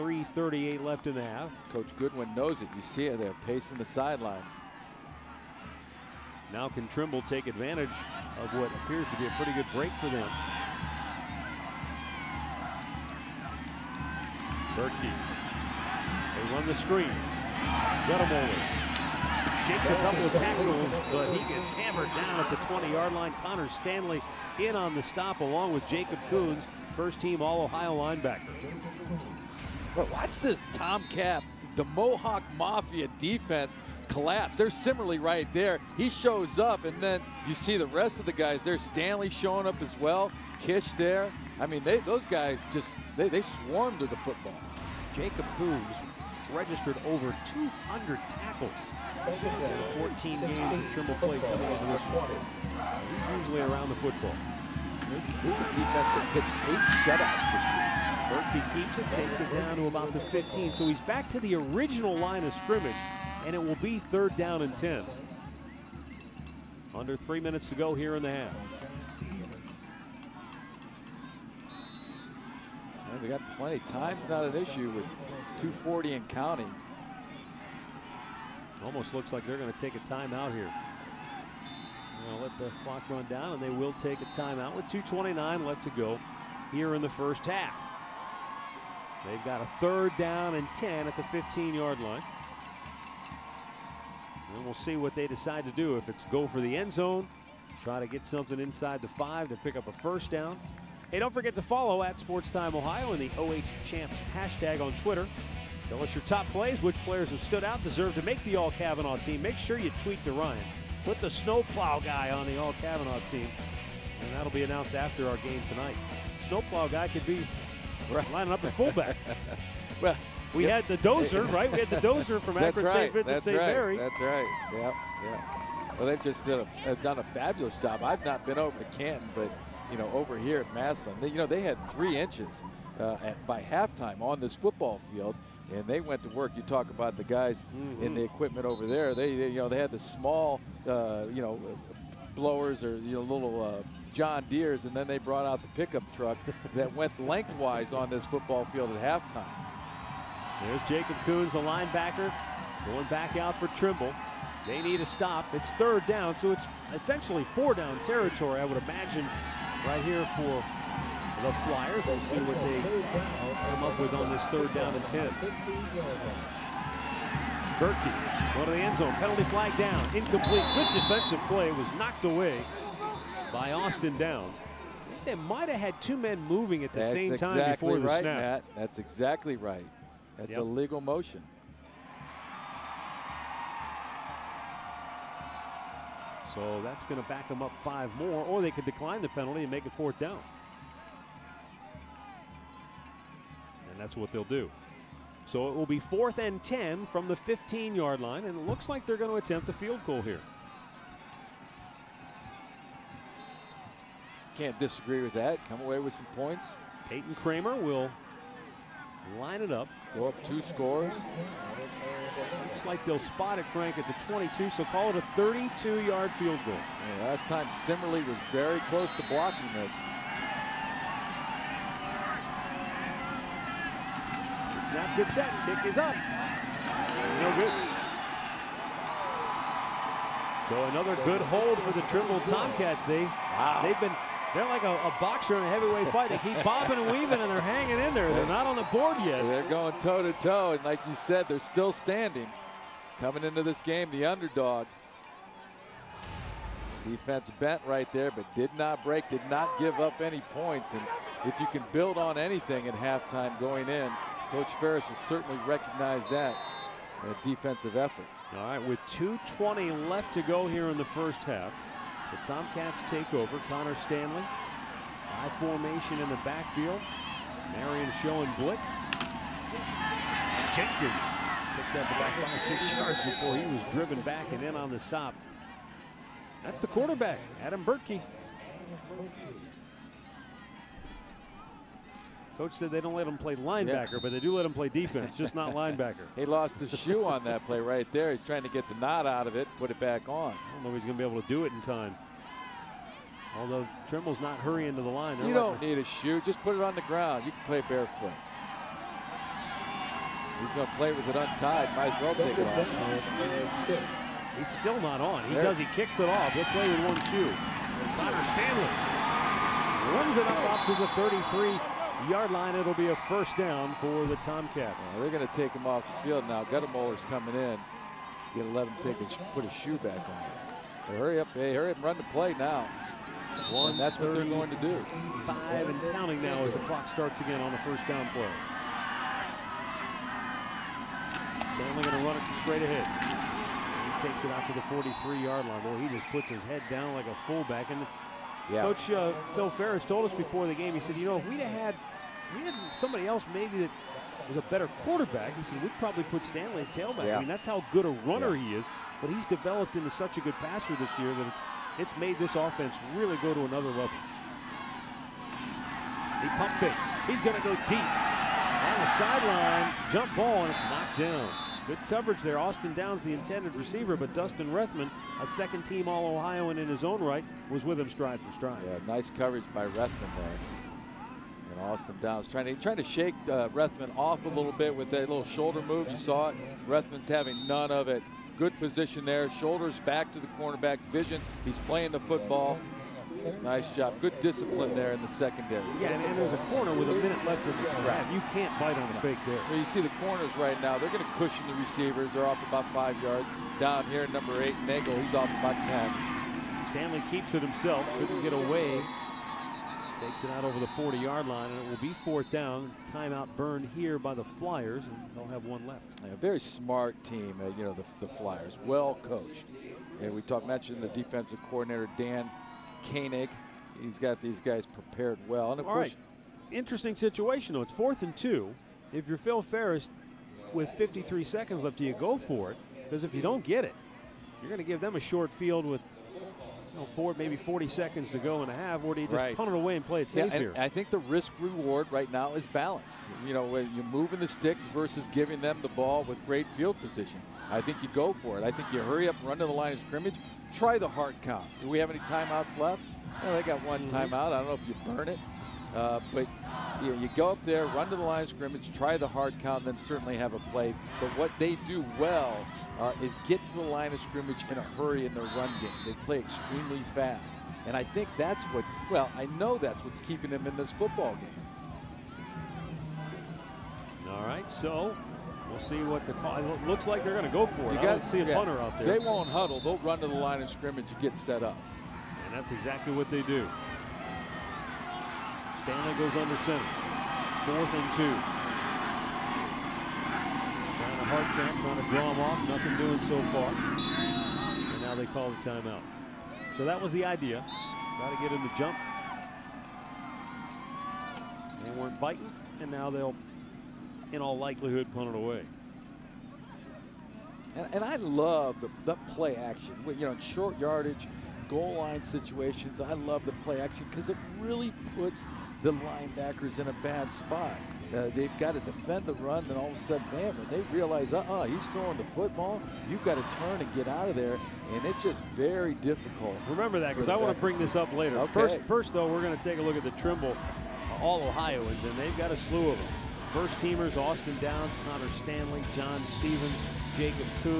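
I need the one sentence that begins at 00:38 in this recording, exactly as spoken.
There's Stanley showing up as well.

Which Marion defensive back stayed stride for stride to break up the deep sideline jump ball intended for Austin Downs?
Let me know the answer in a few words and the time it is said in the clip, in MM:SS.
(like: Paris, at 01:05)
Dustin Rethman, at 06:04.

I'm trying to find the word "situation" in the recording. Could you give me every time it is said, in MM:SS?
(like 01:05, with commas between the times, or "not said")
06:57, 08:22.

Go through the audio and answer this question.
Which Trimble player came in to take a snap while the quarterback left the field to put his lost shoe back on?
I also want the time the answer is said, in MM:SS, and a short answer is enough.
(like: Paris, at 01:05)
Goettemoeller, at 05:16.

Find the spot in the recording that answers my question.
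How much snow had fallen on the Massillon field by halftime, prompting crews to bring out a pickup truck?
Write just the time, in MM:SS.
02:11.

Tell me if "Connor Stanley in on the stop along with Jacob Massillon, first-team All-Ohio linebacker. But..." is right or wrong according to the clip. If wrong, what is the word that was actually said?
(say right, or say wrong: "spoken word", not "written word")
wrong: "Coons", not "Massillon".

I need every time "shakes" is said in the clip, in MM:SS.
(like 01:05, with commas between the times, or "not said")
00:19, 06:13.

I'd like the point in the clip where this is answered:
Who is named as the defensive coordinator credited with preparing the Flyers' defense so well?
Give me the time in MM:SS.
06:52.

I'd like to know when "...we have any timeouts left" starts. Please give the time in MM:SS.
07:21.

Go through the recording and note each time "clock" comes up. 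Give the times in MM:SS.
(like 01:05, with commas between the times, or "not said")
01:22, 05:26.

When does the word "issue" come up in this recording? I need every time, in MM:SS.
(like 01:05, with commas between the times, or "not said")
01:14.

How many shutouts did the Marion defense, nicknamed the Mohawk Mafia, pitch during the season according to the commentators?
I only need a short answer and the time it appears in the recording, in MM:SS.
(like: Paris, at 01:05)
8, at 00:56.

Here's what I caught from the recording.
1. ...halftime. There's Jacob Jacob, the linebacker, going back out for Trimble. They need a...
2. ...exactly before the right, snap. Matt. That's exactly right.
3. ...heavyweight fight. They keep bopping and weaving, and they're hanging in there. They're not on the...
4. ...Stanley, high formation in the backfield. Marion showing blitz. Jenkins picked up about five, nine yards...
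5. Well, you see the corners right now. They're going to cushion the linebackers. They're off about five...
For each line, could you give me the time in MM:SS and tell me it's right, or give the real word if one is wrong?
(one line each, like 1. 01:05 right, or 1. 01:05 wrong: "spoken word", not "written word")
1. 02:29 wrong: "Coons", not "Jacob"
2. 02:57 right
3. 03:55 right
4. 04:23 wrong: "six", not "nine"
5. 06:29 wrong: "receivers", not "linebackers".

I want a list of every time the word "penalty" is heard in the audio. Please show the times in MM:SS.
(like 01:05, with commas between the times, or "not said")
02:49, 03:09.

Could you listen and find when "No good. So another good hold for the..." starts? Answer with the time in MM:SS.
03:46.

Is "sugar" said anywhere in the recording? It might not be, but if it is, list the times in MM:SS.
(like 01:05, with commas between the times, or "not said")
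not said.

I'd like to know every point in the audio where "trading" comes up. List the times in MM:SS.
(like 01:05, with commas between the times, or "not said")
not said.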